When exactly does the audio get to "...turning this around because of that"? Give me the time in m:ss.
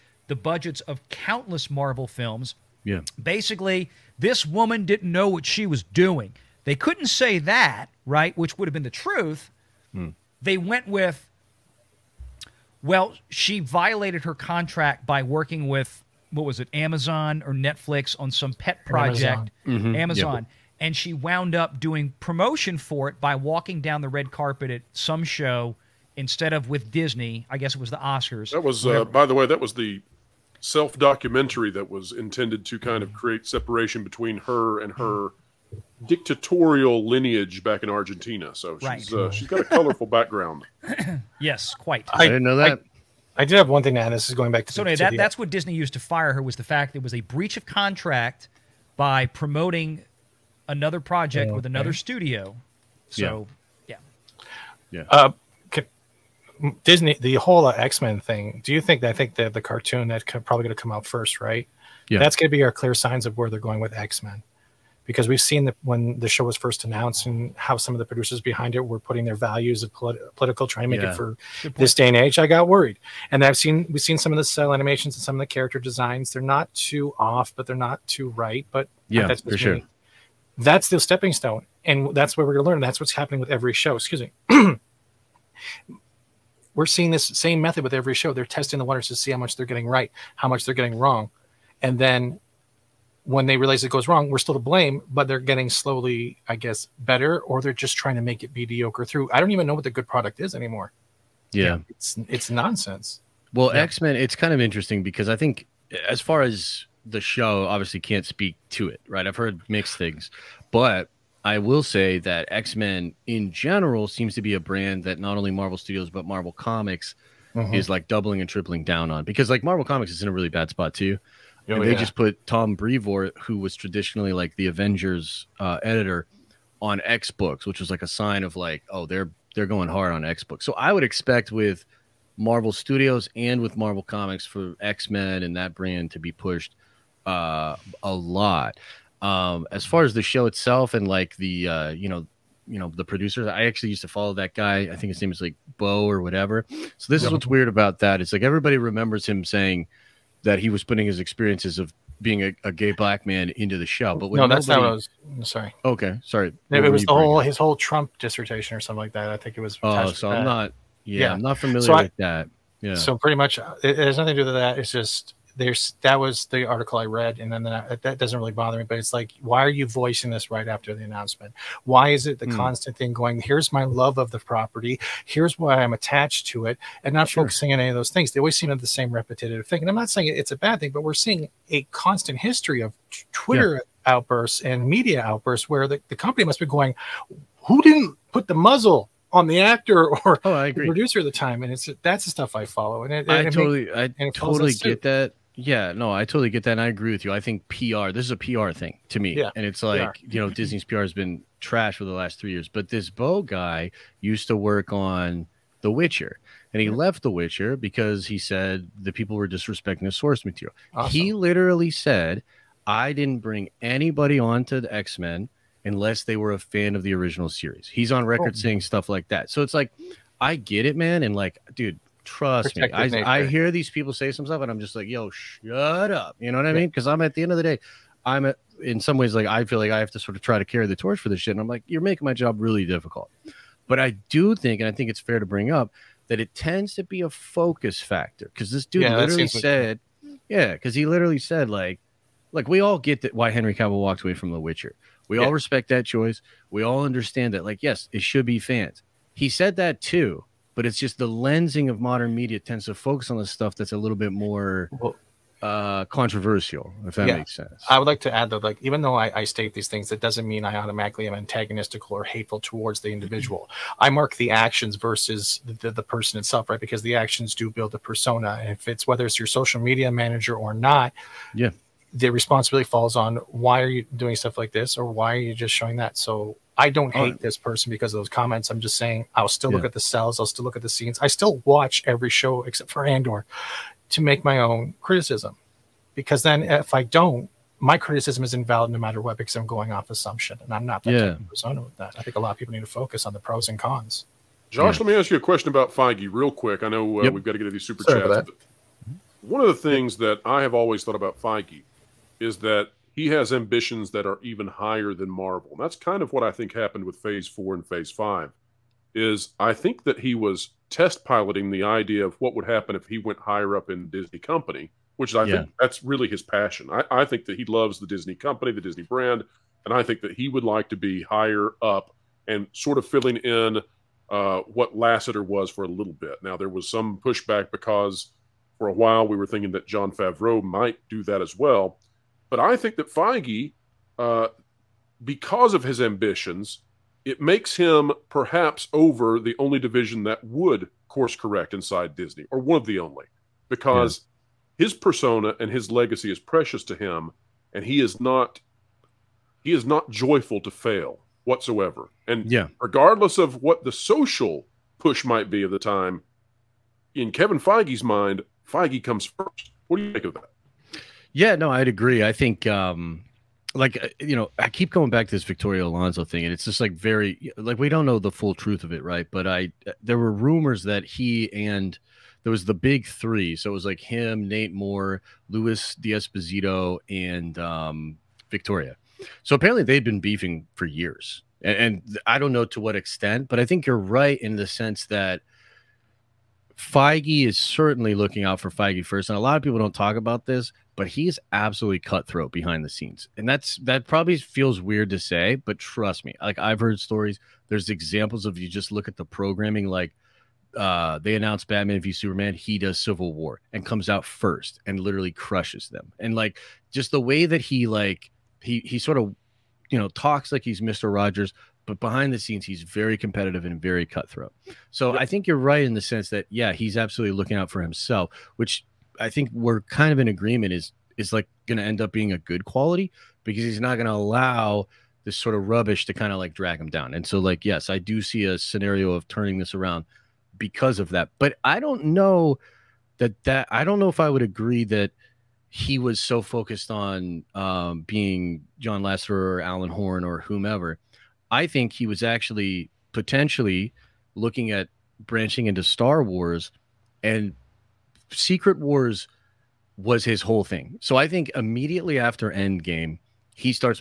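7:09.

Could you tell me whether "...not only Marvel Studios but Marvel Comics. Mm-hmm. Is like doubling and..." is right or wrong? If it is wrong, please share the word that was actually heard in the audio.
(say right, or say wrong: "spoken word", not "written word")
right.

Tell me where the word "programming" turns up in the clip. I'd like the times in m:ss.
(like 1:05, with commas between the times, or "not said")
6:39.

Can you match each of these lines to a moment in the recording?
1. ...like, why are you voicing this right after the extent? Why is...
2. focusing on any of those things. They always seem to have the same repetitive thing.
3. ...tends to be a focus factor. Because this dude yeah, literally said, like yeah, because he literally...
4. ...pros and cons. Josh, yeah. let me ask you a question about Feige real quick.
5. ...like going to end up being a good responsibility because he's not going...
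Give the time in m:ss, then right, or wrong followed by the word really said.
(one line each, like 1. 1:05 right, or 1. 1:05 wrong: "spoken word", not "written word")
1. 2:49 wrong: "announcement", not "extent"
2. 2:57 right
3. 3:56 right
4. 4:53 right
5. 7:01 wrong: "quality", not "responsibility".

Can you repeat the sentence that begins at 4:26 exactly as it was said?
Because the actions do build a persona.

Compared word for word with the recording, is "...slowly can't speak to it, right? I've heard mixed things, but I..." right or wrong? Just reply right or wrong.
wrong.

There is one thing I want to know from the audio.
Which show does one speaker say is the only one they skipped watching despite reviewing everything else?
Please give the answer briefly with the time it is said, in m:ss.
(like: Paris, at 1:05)
Andor, at 4:43.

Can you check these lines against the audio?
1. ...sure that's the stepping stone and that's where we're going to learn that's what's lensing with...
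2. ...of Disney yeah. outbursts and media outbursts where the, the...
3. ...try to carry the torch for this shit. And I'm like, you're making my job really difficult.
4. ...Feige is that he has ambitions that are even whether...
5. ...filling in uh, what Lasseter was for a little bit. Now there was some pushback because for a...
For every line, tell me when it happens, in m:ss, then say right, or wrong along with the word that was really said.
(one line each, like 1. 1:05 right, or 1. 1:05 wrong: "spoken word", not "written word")
1. 1:19 wrong: "happening", not "lensing"
2. 3:02 wrong: "Twitter", not "Disney"
3. 3:50 right
4. 5:01 wrong: "higher", not "whether"
5. 5:23 right.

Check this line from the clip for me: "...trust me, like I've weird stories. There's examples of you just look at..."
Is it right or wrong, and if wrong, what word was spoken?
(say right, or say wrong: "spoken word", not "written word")
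wrong: "heard", not "weird".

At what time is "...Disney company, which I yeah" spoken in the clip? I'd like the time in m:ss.
5:14.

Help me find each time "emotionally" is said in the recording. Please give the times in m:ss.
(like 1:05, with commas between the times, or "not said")
not said.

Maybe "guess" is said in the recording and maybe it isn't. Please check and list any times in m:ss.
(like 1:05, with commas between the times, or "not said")
0:27, 1:36.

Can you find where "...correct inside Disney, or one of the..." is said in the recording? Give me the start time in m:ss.
5:41.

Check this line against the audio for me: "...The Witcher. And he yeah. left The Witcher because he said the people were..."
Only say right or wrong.
right.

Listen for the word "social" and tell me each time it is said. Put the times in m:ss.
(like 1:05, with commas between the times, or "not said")
4:29, 5:53.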